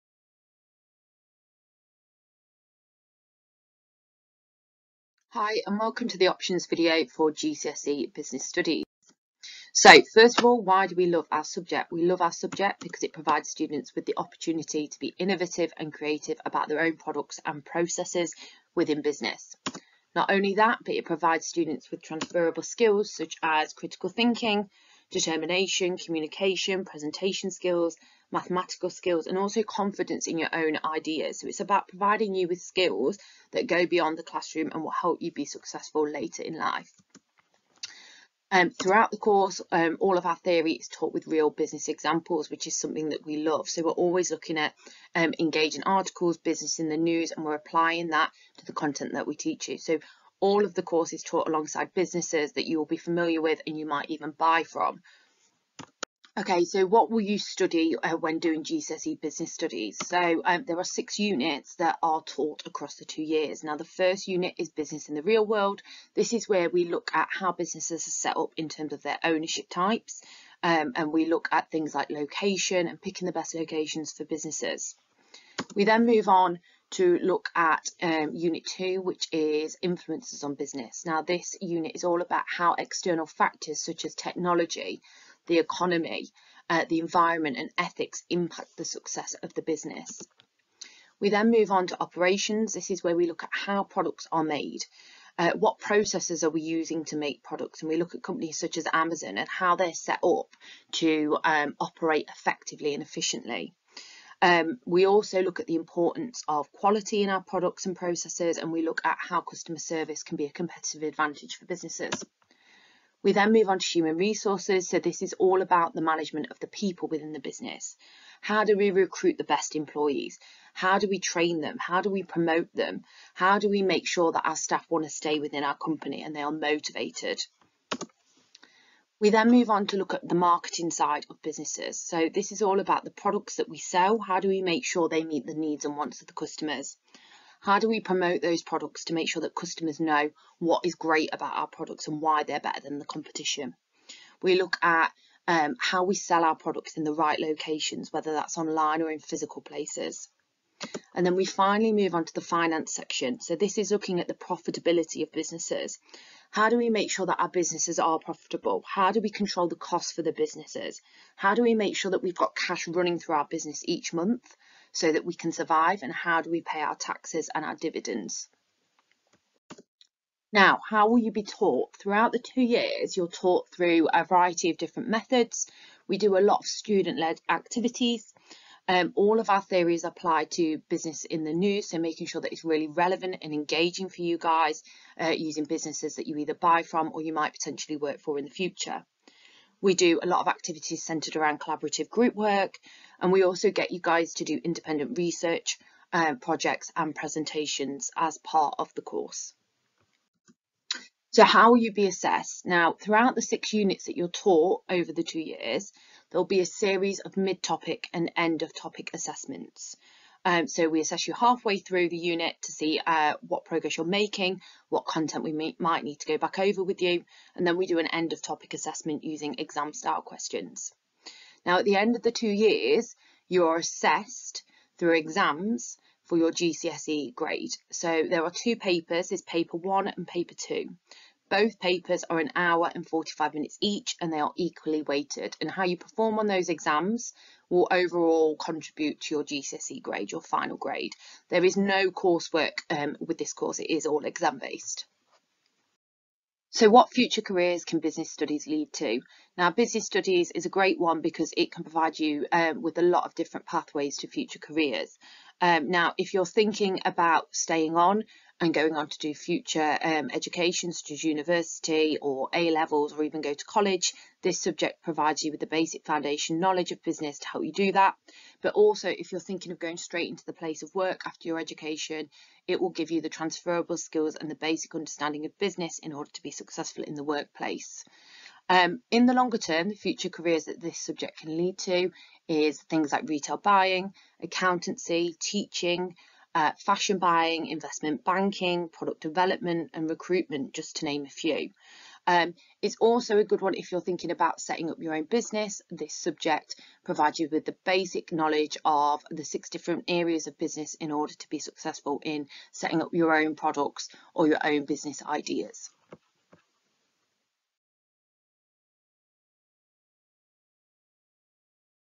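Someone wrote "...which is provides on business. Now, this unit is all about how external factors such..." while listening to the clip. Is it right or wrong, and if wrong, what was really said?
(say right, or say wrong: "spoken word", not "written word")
wrong: "influences", not "provides".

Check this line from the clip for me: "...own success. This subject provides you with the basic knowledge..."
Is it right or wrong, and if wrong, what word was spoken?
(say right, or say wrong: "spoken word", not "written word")
wrong: "business", not "success".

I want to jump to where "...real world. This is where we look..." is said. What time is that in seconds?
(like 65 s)
65 s.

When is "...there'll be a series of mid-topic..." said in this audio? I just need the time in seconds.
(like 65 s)
206 s.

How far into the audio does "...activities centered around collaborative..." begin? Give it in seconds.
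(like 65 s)
190 s.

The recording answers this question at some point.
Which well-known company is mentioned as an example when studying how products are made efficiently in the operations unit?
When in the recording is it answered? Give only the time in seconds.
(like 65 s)
98 s.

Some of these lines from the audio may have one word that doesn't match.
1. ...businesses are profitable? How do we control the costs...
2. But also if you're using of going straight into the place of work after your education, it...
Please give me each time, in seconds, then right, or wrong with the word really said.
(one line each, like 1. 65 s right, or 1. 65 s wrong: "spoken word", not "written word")
1. 157 s right
2. 268 s wrong: "thinking", not "using".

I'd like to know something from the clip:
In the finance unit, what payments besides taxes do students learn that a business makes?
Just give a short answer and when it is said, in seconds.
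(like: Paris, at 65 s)
Dividends, at 167 s.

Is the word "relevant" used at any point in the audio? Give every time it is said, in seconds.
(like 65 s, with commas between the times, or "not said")
182 s.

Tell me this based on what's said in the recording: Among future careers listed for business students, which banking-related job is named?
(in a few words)
Investment banking.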